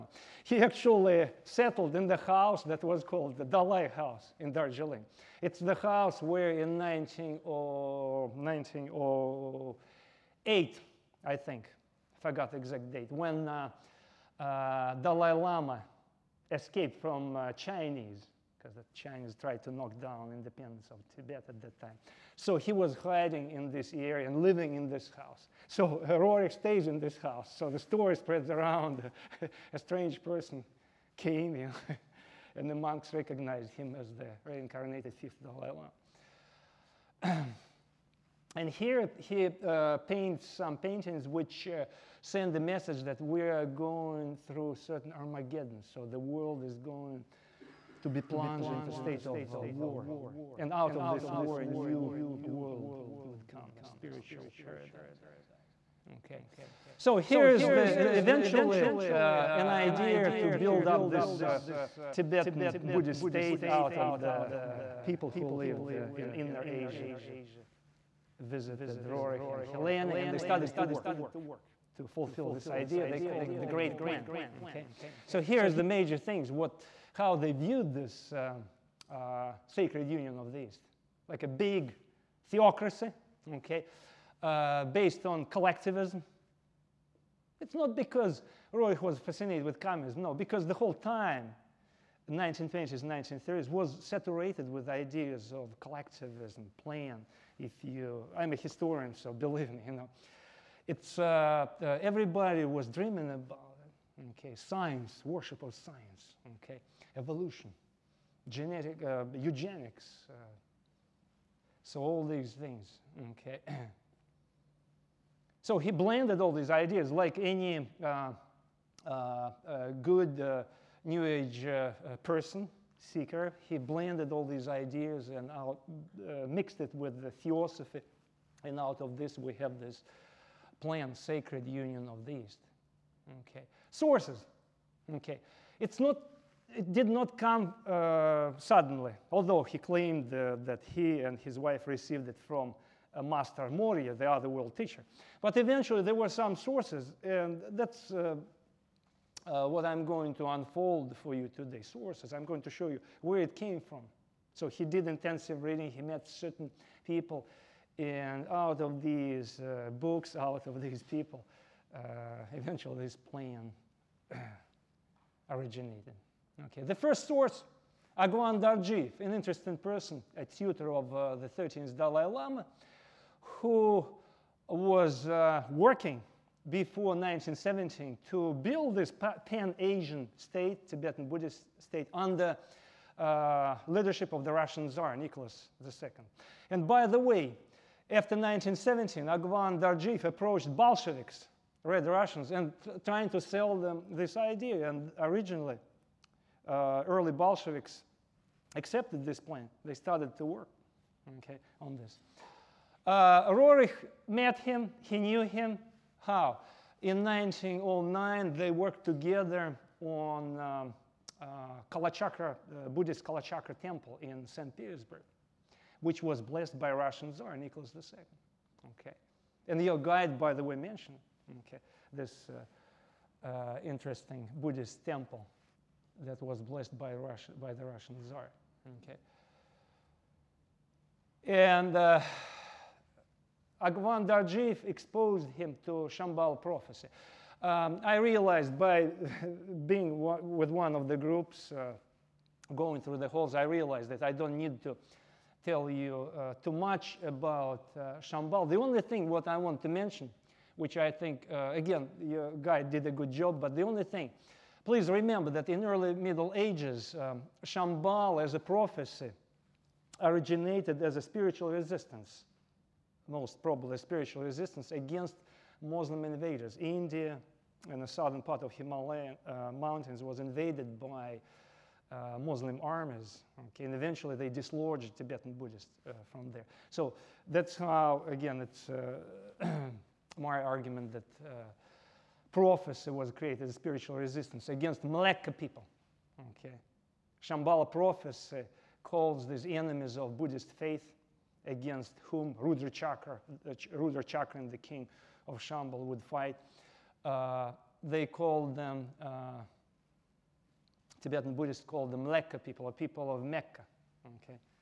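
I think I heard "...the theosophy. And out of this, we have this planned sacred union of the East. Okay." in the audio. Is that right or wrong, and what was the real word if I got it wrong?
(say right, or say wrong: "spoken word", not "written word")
right.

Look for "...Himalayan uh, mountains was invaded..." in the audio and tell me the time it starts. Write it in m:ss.
4:28.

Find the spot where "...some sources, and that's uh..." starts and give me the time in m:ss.
2:26.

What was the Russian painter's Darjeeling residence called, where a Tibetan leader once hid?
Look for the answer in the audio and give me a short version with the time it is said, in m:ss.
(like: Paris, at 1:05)
Dalai House, at 0:03.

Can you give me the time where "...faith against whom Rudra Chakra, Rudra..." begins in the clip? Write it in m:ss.
4:50.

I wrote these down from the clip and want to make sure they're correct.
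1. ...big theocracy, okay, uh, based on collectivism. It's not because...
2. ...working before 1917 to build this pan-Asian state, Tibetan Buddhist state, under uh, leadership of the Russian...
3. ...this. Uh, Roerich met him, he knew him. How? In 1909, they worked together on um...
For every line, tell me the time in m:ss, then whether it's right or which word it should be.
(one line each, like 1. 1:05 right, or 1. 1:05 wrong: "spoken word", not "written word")
1. 1:21 right
2. 2:55 right
3. 3:21 right.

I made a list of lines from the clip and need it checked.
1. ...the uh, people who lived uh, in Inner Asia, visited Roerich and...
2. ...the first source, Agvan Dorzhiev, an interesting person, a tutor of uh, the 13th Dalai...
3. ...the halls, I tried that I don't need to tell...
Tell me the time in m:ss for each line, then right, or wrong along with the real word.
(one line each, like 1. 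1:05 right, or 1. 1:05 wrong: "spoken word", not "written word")
1. 1:04 right
2. 2:46 right
3. 4:03 wrong: "realized", not "tried".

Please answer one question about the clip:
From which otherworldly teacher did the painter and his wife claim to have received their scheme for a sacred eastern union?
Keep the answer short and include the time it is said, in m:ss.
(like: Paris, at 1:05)
Master Moria, at 2:23.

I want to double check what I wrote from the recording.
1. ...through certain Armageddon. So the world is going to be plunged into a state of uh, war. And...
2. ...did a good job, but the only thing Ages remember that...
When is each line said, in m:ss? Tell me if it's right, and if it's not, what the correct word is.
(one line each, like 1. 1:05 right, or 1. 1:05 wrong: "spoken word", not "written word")
1. 0:44 right
2. 4:12 wrong: "Please", not "Ages".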